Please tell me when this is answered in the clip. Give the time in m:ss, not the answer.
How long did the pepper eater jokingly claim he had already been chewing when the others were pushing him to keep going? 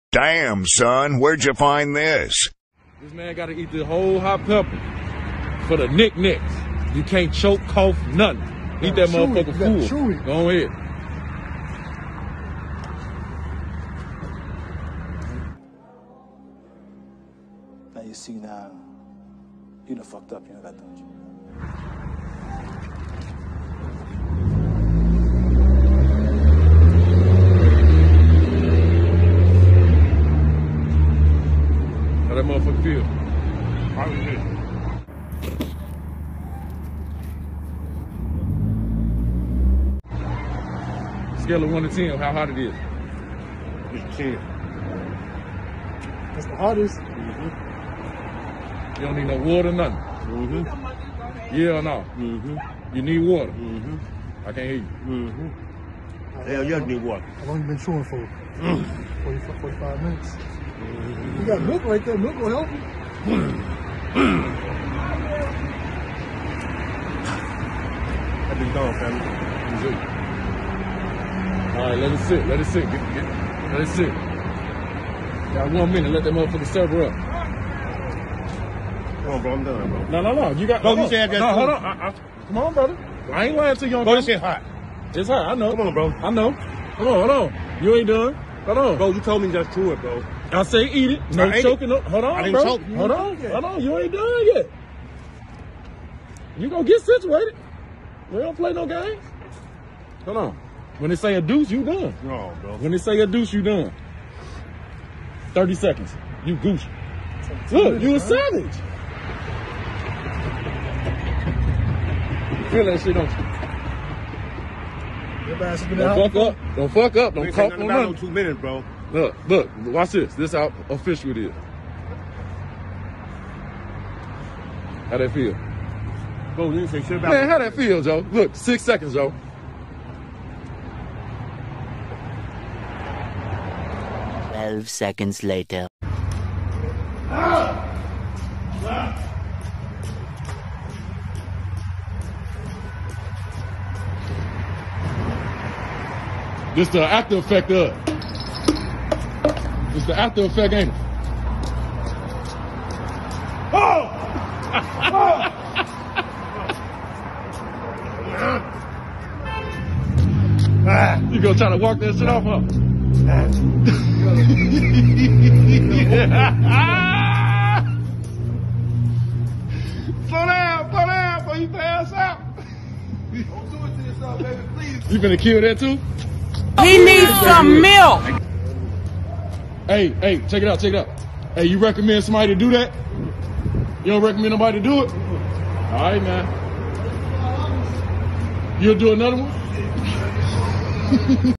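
0:59.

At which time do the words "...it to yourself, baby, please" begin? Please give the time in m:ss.
2:53.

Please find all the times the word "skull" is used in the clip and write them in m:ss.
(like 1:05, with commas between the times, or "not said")
not said.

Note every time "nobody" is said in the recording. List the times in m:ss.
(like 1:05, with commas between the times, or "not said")
3:04.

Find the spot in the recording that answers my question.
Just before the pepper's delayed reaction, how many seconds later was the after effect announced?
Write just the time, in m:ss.
2:14.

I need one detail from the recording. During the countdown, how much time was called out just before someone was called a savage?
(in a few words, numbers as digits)
30 seconds.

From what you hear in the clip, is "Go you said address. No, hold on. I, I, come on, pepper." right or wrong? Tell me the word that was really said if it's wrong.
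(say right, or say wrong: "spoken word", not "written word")
wrong: "brother", not "pepper".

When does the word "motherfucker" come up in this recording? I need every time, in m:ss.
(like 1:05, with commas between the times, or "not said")
0:09, 1:16.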